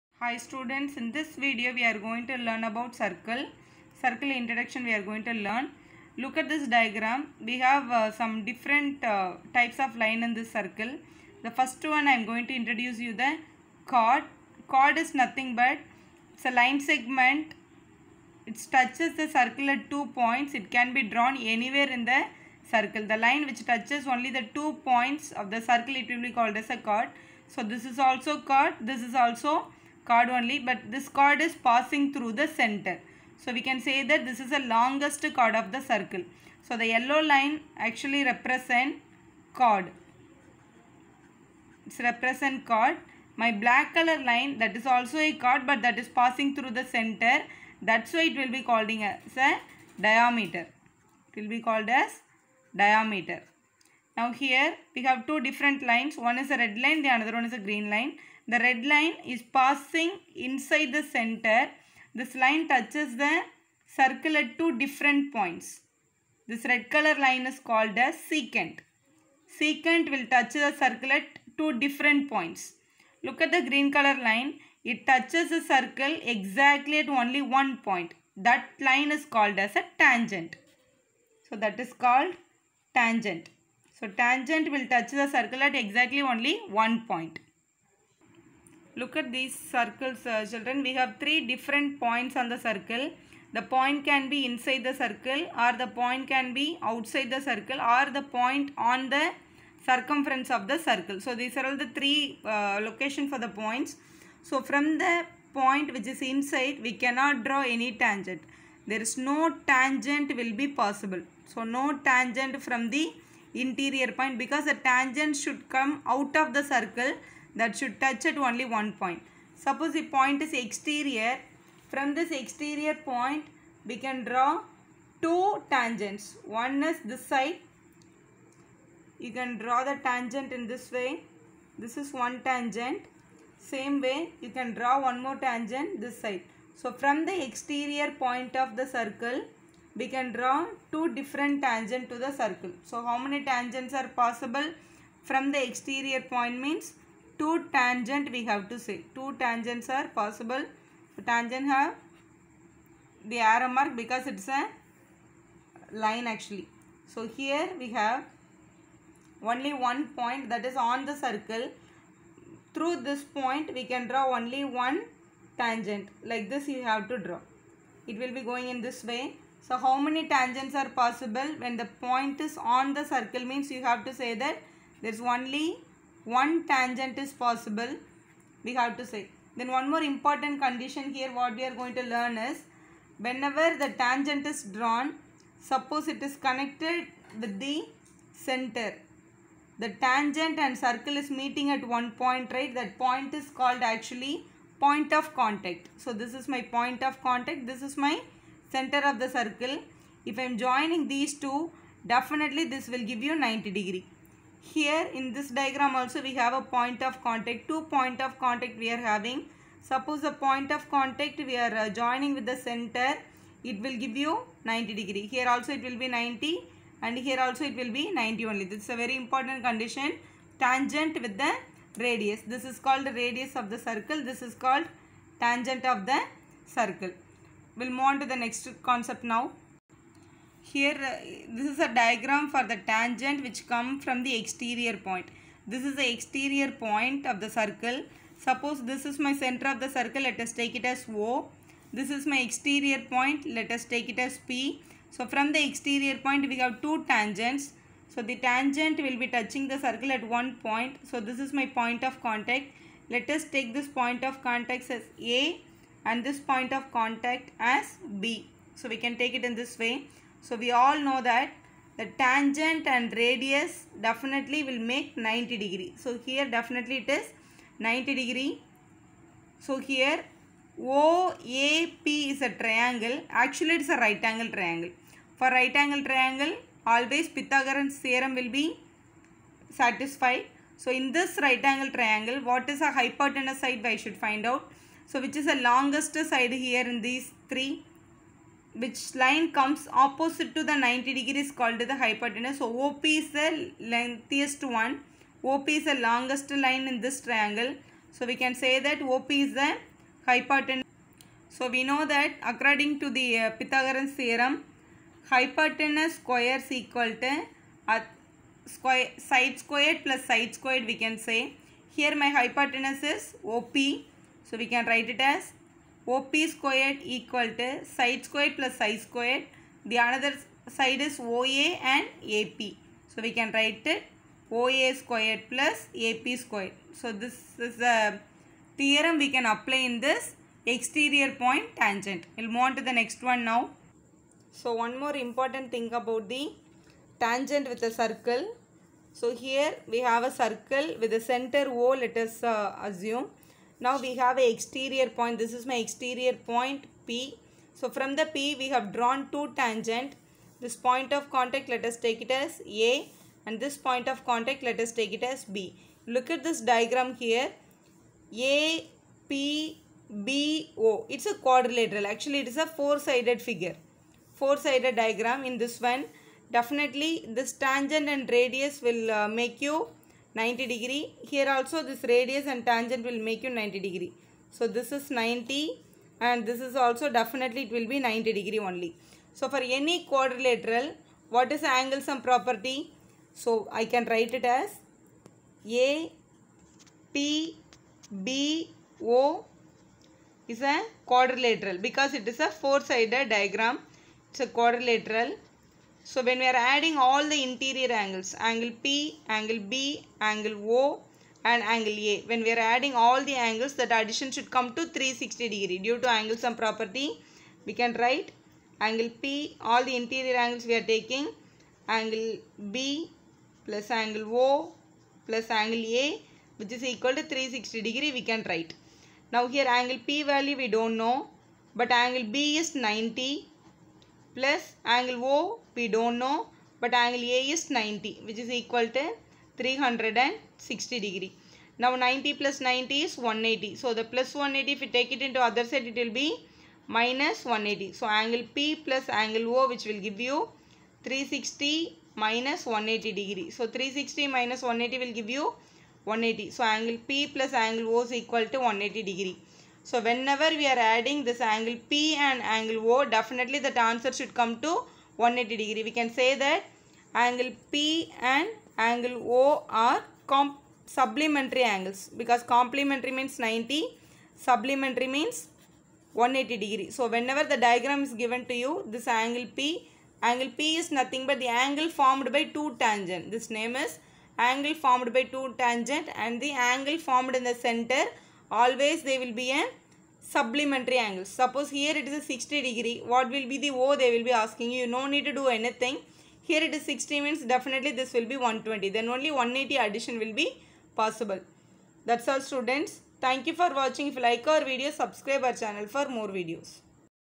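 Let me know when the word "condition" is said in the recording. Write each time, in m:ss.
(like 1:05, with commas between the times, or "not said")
3:00, 3:39.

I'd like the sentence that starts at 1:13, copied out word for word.
Look at the green color line.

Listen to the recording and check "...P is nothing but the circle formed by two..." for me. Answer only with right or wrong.
wrong.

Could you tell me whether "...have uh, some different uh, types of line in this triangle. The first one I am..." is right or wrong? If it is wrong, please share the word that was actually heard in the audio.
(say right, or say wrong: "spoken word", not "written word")
wrong: "circle", not "triangle".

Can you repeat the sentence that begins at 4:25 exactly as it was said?
So here definitely it is 90 degree.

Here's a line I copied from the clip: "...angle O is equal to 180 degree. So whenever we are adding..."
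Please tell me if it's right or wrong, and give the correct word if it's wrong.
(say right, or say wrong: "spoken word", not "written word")
right.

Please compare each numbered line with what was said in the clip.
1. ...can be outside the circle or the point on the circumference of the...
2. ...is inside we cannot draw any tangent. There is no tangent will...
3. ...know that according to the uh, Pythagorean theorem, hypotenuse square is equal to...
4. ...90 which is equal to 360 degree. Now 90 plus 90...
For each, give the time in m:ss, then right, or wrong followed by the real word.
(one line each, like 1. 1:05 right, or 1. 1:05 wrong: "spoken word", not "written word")
1. 1:36 right
2. 1:46 right
3. 5:01 right
4. 7:07 right.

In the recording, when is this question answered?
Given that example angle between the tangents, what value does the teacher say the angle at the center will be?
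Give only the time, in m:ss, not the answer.
8:08.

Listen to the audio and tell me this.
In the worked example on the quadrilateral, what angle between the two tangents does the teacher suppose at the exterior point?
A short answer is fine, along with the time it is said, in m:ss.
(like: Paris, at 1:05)
60 degrees, at 8:02.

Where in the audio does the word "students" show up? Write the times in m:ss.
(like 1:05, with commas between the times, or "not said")
0:00, 8:12.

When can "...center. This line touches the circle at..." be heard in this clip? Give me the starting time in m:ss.
1:01.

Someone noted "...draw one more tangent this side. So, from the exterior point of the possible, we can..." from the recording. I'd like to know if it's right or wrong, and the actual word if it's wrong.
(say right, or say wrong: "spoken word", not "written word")
wrong: "circle", not "possible".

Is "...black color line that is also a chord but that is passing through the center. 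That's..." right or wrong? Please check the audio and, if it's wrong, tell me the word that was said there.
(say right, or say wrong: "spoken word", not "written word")
right.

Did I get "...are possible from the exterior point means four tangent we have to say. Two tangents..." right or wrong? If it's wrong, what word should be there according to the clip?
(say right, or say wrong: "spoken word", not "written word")
wrong: "two", not "four".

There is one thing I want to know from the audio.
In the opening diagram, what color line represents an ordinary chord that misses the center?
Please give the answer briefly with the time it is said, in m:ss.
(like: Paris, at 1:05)
Yellow, at 0:36.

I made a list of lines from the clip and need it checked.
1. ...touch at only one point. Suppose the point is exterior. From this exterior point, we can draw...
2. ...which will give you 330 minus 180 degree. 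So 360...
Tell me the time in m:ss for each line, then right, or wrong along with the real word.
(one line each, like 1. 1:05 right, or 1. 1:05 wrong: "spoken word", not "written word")
1. 1:57 right
2. 7:19 wrong: "360", not "330".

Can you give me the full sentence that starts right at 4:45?
So which is the longest side here in these three?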